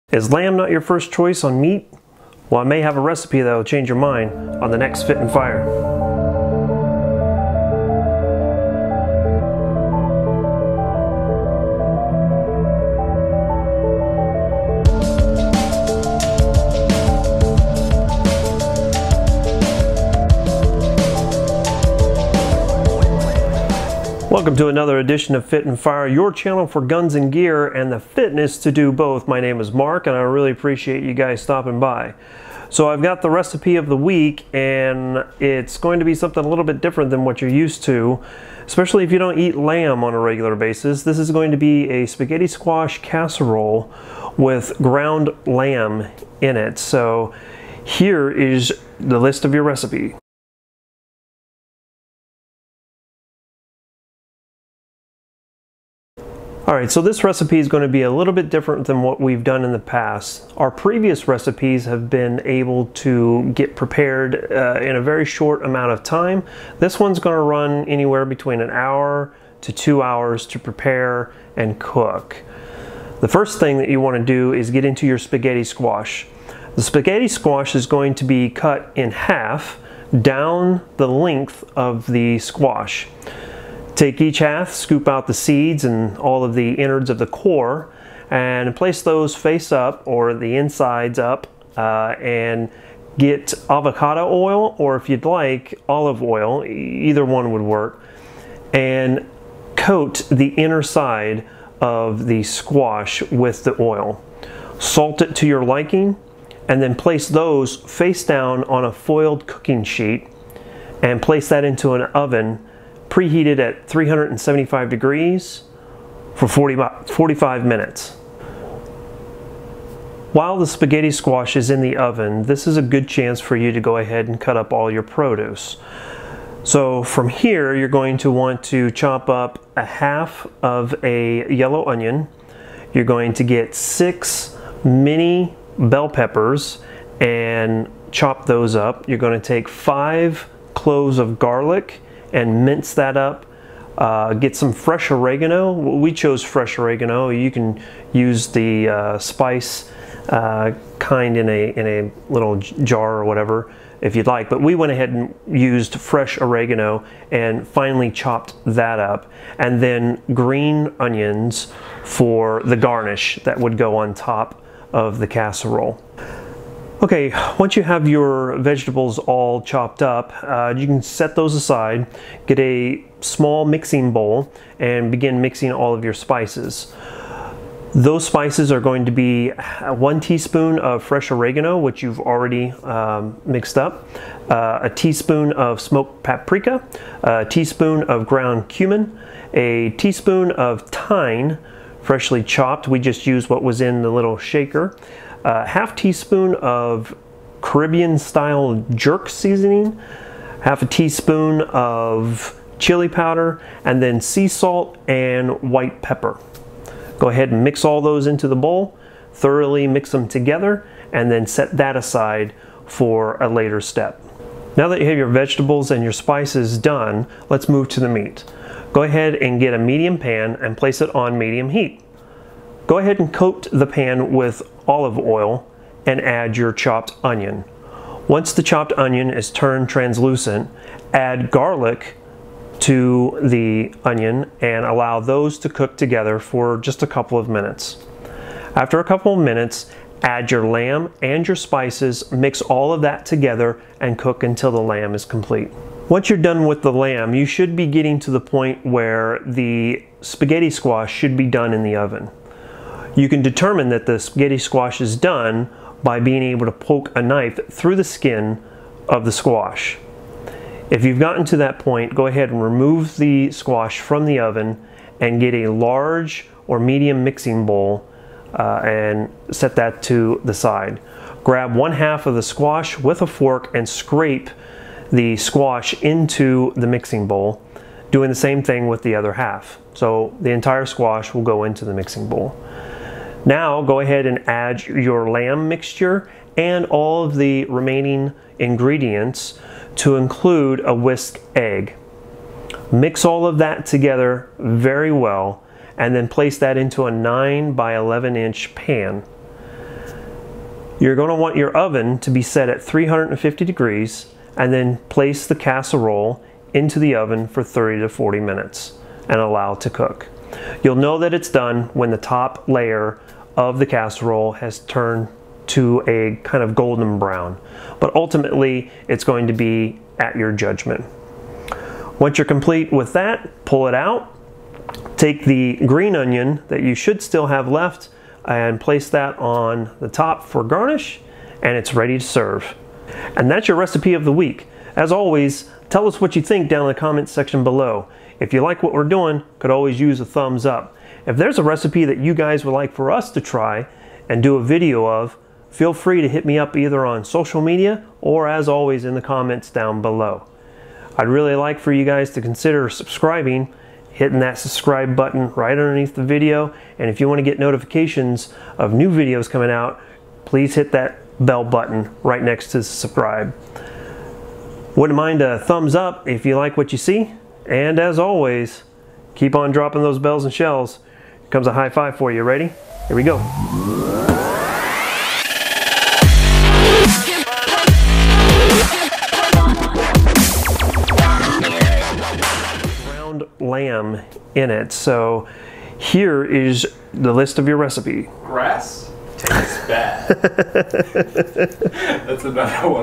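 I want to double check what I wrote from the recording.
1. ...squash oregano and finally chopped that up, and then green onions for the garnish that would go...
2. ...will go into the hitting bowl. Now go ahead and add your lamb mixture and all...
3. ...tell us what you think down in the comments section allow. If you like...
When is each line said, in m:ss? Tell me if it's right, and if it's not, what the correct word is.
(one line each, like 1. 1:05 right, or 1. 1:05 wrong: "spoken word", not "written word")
1. 2:35 wrong: "fresh", not "squash"
2. 4:41 wrong: "mixing", not "hitting"
3. 5:35 wrong: "below", not "allow".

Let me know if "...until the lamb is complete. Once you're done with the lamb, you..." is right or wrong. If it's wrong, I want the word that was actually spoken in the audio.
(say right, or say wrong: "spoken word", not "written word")
right.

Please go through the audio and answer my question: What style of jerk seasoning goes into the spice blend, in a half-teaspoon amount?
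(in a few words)
Caribbean style.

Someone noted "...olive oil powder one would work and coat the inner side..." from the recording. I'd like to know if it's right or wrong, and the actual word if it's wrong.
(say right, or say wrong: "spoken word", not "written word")
wrong: "either", not "powder".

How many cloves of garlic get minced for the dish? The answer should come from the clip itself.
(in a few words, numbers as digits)
5.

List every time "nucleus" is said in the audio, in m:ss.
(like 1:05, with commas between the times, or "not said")
not said.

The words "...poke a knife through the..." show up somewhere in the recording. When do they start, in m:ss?
4:16.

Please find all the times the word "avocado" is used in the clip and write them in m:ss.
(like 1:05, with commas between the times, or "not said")
1:33.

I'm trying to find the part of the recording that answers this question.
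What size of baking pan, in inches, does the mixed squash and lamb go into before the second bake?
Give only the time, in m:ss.
4:57.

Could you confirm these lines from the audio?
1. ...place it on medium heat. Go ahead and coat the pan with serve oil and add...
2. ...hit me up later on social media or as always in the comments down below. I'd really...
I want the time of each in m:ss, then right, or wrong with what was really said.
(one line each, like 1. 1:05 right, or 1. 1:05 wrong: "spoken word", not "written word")
1. 3:40 wrong: "olive", not "serve"
2. 5:46 wrong: "either", not "later".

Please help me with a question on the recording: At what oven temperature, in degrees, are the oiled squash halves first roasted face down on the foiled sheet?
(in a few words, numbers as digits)
375.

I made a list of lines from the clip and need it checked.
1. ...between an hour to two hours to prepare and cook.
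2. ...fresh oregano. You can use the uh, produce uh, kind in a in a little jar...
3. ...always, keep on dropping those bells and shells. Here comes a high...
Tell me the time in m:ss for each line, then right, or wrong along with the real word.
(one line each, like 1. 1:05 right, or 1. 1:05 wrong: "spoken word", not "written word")
1. 1:08 right
2. 2:26 wrong: "spice", not "produce"
3. 6:08 right.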